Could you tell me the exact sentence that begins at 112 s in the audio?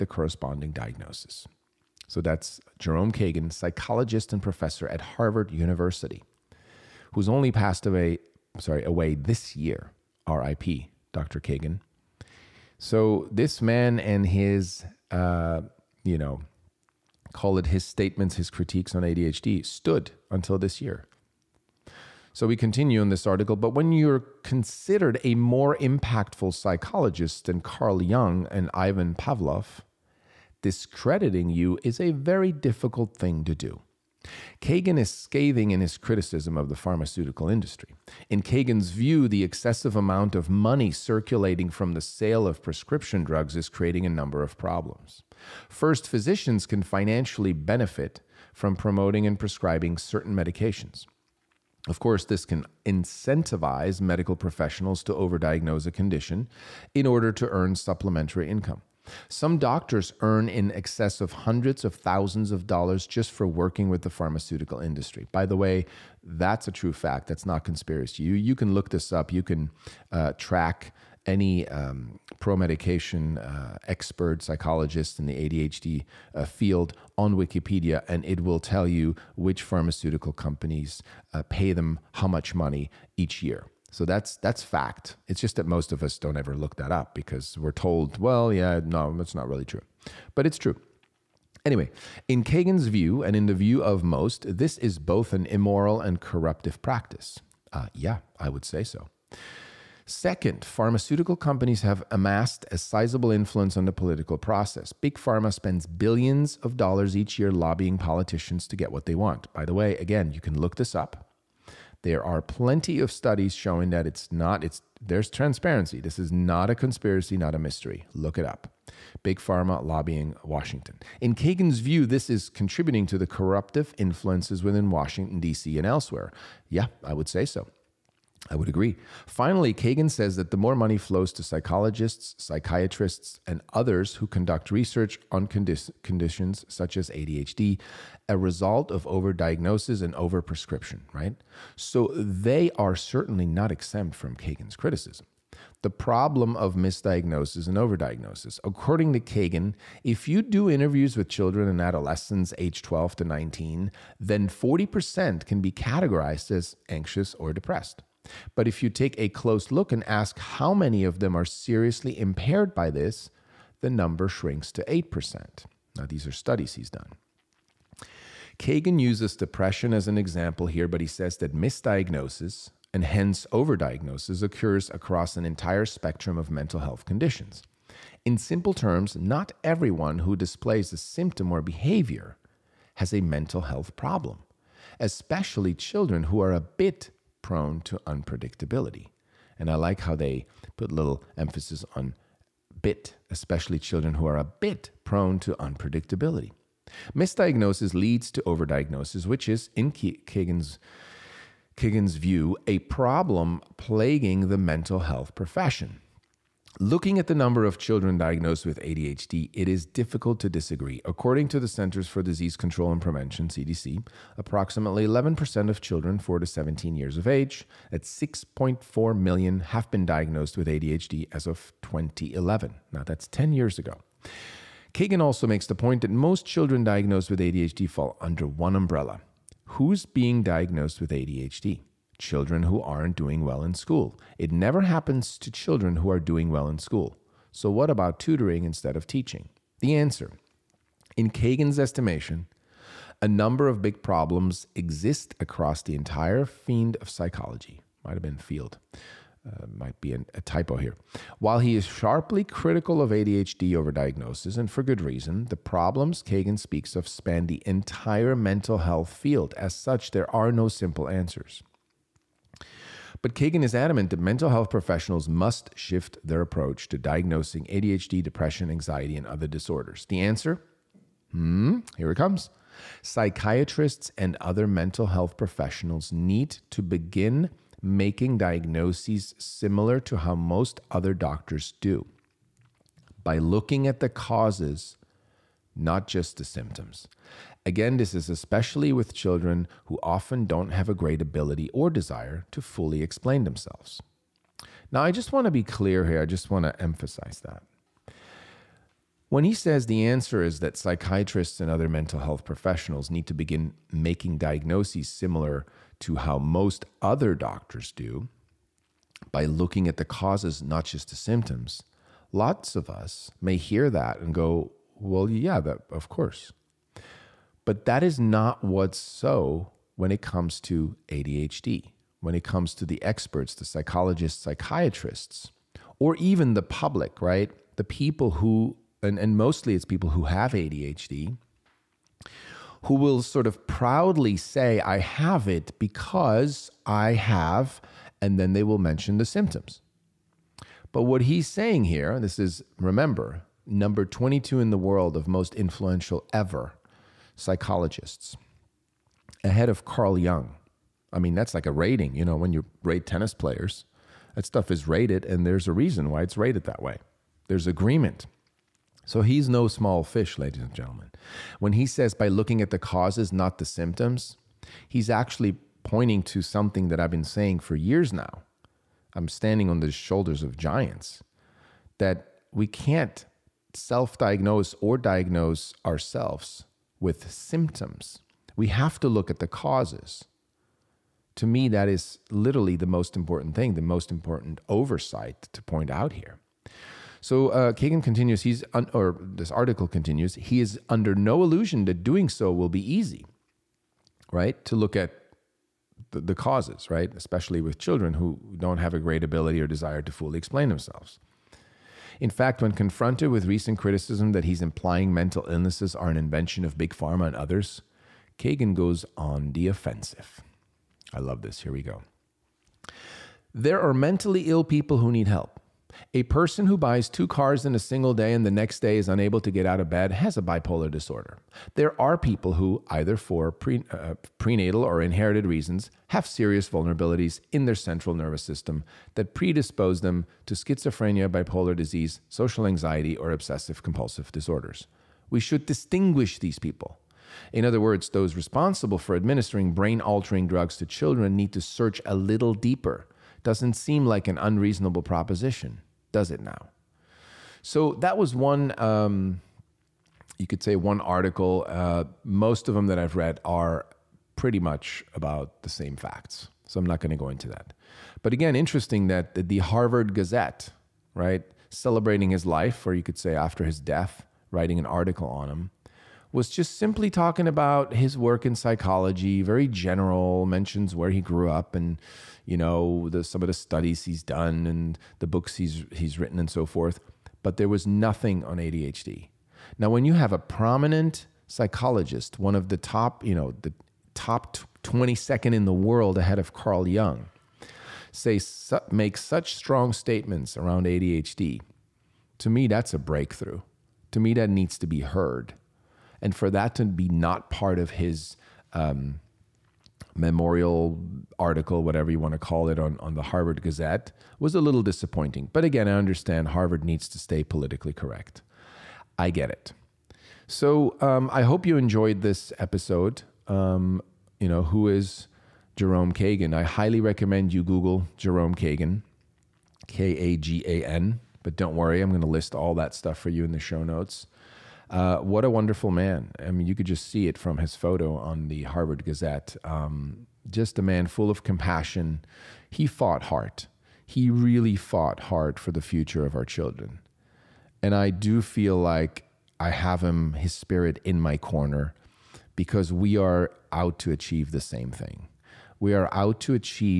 There are plenty of studies showing that it's not, it's there's transparency.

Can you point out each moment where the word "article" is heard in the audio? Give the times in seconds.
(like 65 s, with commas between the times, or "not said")
23 s, 389 s, 450 s, 464 s, 501 s.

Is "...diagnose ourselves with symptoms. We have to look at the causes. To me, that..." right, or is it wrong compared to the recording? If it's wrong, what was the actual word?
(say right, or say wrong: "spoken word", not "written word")
right.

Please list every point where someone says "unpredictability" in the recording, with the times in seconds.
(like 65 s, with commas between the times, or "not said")
188 s, 195 s.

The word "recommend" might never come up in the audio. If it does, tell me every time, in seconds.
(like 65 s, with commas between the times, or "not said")
517 s.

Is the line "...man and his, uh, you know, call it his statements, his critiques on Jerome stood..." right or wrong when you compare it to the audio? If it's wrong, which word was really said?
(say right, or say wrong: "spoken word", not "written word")
wrong: "ADHD", not "Jerome".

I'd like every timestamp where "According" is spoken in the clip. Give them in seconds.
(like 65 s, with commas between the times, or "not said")
148 s, 211 s.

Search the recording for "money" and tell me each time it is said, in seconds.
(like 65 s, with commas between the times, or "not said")
40 s, 82 s, 130 s.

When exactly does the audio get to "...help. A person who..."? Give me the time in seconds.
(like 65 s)
415 s.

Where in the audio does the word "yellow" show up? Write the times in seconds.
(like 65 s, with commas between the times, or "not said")
not said.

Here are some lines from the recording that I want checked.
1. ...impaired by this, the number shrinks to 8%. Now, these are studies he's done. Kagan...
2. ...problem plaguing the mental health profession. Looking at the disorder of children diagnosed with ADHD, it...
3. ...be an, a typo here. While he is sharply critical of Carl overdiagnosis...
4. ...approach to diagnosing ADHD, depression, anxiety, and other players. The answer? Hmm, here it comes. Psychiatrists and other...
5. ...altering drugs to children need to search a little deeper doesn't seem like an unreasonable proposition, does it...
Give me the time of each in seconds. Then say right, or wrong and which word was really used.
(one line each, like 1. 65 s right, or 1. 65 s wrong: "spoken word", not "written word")
1. 162 s right
2. 202 s wrong: "number", not "disorder"
3. 250 s wrong: "ADHD", not "Carl"
4. 266 s wrong: "disorders", not "players"
5. 439 s right.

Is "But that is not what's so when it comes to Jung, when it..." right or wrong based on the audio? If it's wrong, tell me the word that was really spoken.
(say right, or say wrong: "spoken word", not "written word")
wrong: "ADHD", not "Jung".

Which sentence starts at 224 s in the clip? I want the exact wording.
Kagan also makes the point that most children diagnosed with ADHD fall under one umbrella.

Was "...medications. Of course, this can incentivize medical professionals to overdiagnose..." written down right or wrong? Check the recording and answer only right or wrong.
right.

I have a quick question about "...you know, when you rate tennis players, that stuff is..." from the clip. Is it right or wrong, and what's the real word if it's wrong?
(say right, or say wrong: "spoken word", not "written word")
right.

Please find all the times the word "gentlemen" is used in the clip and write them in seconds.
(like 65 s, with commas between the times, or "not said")
360 s.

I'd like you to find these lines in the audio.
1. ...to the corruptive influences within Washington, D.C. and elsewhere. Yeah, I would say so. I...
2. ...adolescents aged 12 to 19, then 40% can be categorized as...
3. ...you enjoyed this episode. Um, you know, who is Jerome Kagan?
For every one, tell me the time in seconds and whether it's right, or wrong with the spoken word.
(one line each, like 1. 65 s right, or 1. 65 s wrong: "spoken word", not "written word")
1. 123 s right
2. 151 s right
3. 511 s right.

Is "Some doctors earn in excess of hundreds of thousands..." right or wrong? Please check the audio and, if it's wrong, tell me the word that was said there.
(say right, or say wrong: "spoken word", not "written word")
right.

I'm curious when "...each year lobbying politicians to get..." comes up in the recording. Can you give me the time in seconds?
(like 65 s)
107 s.